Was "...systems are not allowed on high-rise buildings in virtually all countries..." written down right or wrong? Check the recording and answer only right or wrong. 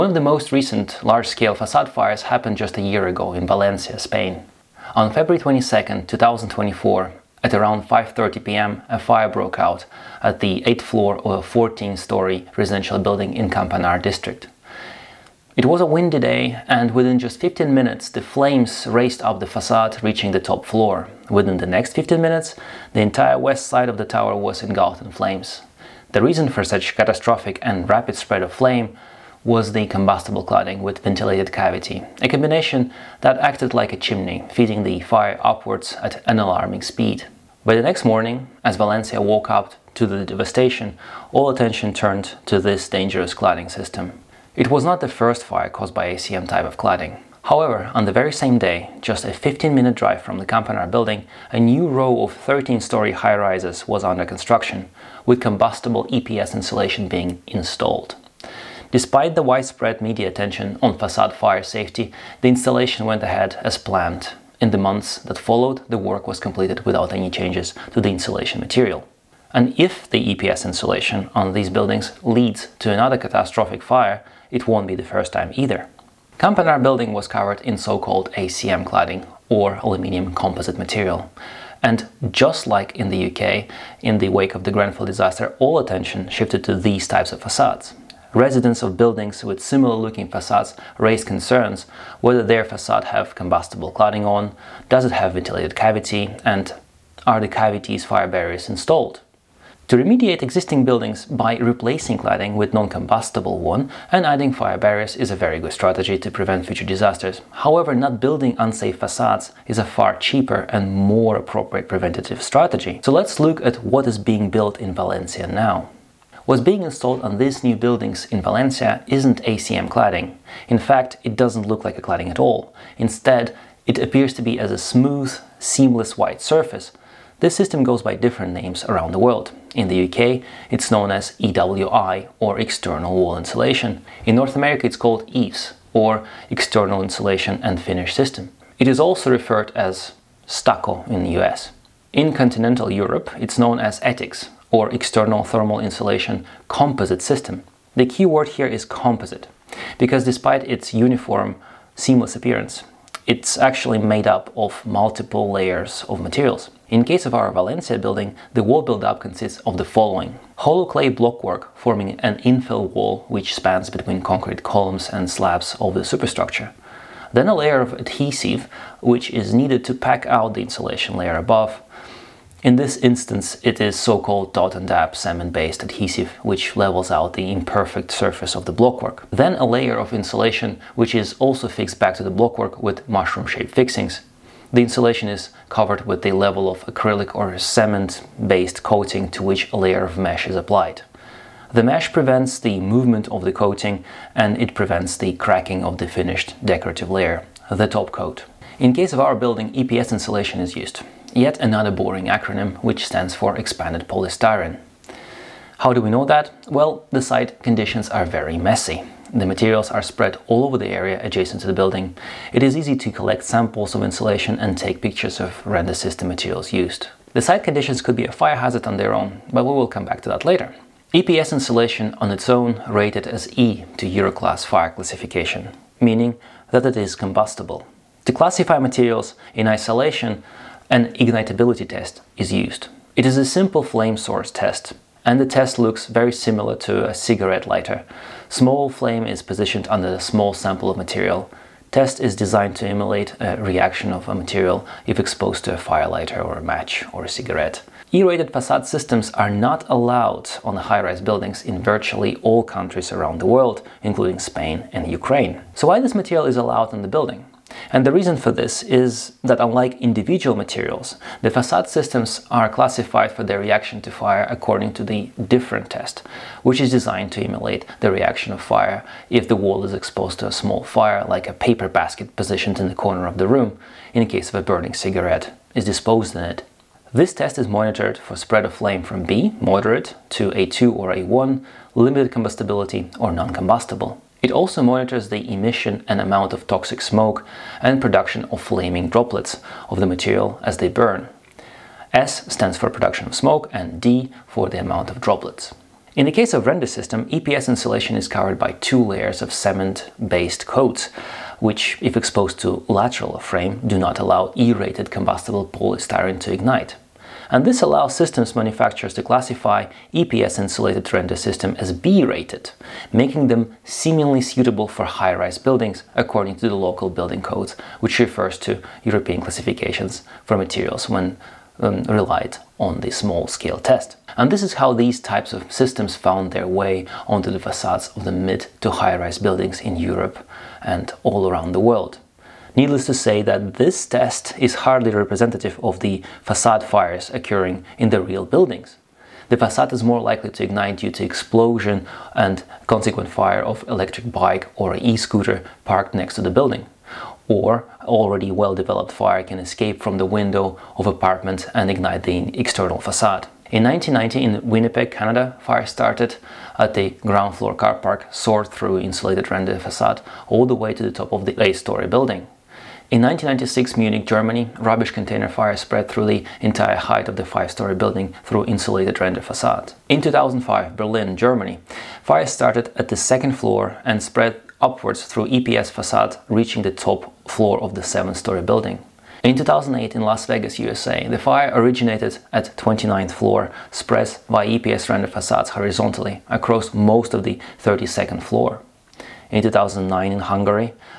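right.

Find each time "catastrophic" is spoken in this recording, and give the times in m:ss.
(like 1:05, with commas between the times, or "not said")
0:26, 1:13.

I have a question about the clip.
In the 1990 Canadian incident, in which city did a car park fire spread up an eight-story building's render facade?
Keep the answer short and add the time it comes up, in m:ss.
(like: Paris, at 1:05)
Winnipeg, at 5:54.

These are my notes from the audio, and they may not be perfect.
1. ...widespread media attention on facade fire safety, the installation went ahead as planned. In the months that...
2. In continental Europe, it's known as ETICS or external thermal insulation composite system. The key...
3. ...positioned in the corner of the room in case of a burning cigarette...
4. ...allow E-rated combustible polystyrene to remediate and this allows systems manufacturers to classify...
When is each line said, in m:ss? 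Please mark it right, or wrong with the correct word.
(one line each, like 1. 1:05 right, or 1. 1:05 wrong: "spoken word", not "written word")
1. 0:59 right
2. 2:22 right
3. 4:32 right
4. 5:04 wrong: "ignite", not "remediate".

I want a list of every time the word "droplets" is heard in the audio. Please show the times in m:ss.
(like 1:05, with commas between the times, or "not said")
4:49, 4:55.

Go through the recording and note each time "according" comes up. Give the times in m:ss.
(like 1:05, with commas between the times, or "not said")
4:24, 5:16.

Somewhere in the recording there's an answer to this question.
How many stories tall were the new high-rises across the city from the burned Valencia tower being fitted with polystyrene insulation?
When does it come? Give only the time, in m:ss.
0:52.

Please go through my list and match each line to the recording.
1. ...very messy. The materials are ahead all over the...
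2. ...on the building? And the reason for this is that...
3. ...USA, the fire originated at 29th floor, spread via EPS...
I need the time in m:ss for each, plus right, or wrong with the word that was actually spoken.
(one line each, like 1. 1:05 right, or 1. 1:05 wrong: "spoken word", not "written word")
1. 3:28 wrong: "spread", not "ahead"
2. 4:16 right
3. 6:20 right.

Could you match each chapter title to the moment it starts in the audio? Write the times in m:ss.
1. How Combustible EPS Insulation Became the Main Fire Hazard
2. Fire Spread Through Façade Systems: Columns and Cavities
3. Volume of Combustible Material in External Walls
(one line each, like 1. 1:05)
1. 0:44
2. 2:44
3. 4:45.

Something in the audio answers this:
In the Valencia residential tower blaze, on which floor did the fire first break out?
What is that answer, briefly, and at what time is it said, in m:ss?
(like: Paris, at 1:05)
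8th floor, at 0:10.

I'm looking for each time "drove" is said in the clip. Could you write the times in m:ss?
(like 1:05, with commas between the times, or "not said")
not said.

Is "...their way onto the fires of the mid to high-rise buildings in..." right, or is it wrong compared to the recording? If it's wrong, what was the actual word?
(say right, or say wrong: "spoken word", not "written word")
wrong: "facades", not "fires".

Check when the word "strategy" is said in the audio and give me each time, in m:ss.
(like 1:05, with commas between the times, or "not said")
1:45, 1:52.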